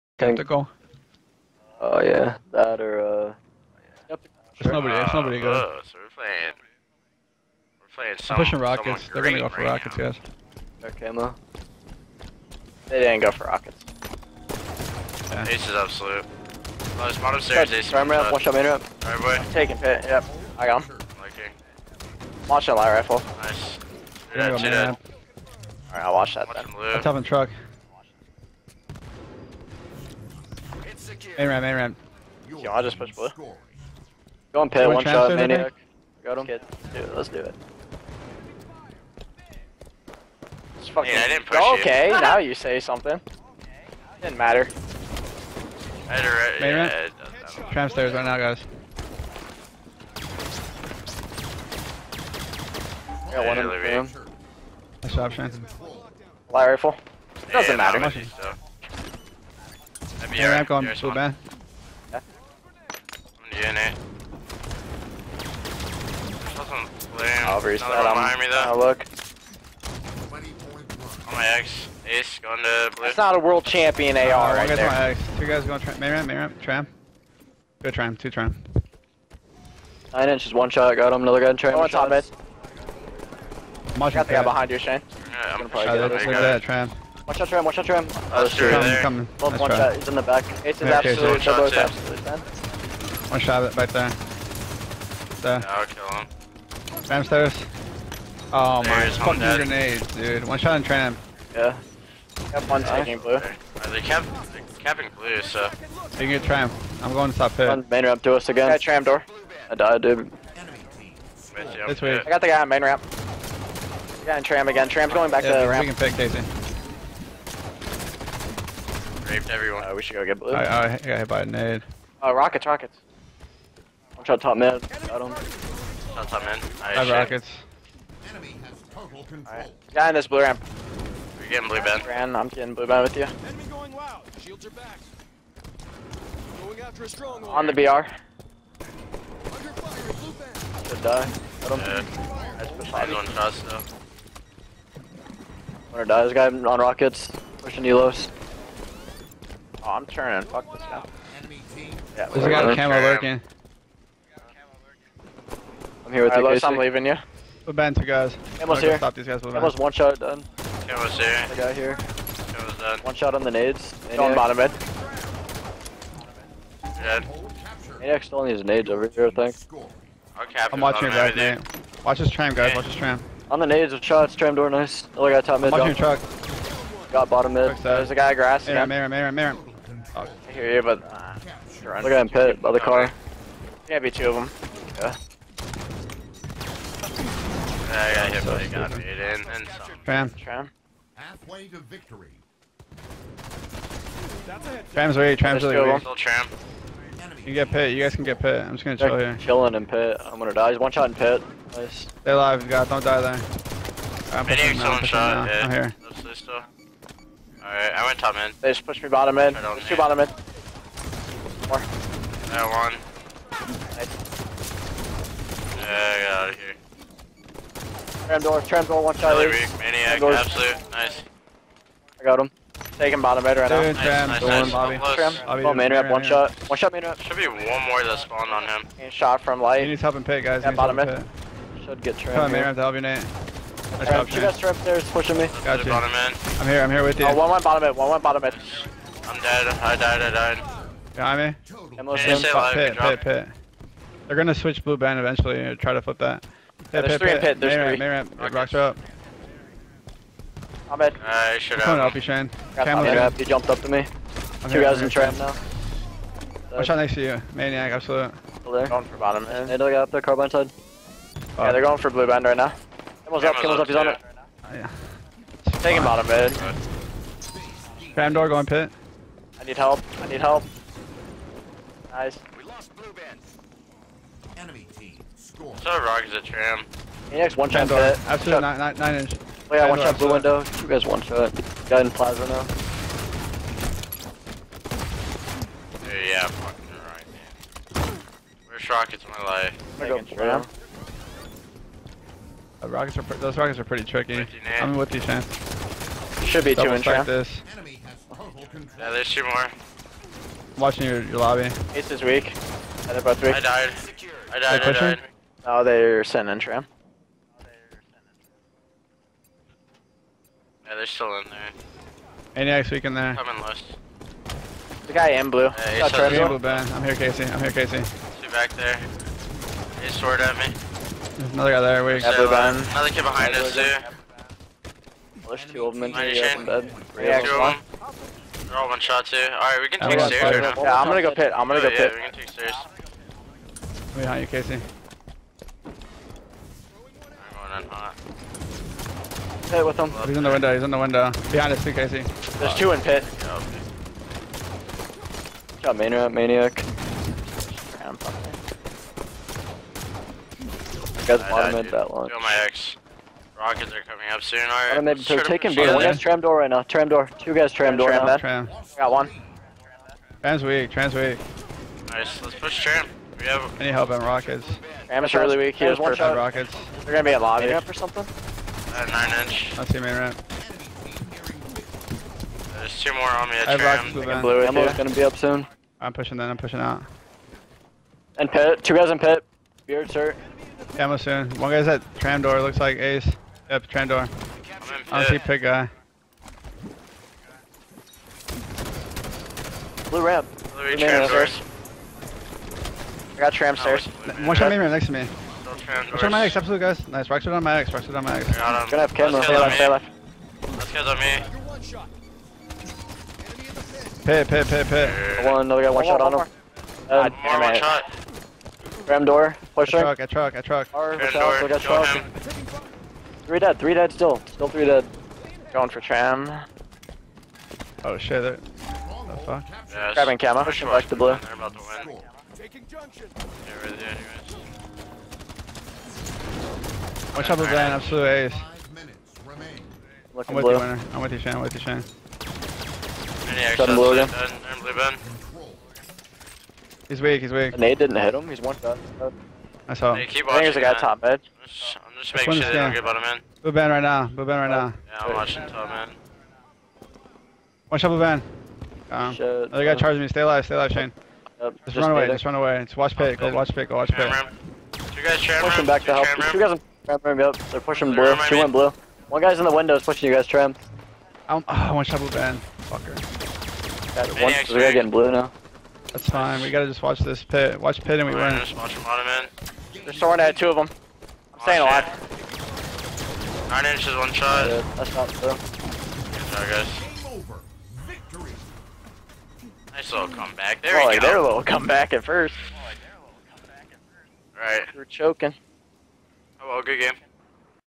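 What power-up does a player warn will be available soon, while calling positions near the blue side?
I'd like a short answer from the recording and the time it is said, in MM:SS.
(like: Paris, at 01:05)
Ammo, at 06:14.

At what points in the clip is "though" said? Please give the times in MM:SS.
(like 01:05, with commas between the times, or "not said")
01:08, 02:23.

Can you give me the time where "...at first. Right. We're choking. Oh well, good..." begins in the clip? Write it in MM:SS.
08:03.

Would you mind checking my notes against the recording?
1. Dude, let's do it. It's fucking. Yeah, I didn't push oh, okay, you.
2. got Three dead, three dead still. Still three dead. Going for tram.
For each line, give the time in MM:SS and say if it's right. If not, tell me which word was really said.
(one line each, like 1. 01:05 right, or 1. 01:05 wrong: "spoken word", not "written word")
1. 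00:36 right
2. 06:50 right.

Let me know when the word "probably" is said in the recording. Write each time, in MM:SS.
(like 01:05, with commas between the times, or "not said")
01:25.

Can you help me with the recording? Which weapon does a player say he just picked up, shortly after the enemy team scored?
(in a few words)
Plasma.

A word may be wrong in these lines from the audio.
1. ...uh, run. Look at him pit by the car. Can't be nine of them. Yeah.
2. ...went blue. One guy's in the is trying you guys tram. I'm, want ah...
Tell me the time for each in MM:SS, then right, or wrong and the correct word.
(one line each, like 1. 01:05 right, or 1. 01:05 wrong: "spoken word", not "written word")
1. 03:01 wrong: "two", not "nine"
2. 07:38 wrong: "pushing", not "trying".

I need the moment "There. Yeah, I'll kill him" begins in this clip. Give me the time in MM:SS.
01:35.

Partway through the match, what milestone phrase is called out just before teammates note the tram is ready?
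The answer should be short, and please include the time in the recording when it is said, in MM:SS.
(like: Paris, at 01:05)
Halfway to victory, at 03:11.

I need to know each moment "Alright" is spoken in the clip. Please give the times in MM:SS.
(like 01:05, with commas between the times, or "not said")
00:25, 03:27, 05:29.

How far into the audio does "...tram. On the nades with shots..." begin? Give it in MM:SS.
02:52.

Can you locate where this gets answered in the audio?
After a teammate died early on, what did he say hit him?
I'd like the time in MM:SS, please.
02:00.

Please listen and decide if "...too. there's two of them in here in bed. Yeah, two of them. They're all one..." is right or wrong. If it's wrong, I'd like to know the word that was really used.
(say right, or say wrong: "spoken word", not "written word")
right.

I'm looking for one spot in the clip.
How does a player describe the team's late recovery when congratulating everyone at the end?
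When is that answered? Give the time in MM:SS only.
07:59.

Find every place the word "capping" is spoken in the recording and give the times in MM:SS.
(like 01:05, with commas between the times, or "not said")
01:44.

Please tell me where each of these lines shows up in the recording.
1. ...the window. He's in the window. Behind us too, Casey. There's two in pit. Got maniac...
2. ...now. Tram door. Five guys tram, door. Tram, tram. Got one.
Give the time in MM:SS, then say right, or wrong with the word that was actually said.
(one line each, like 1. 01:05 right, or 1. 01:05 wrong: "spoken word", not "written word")
1. 05:40 right
2. 05:56 wrong: "Two", not "Five".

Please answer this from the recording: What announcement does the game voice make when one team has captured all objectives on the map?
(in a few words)
Enemy has total control.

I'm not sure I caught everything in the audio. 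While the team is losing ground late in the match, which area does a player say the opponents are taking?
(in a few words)
Junction.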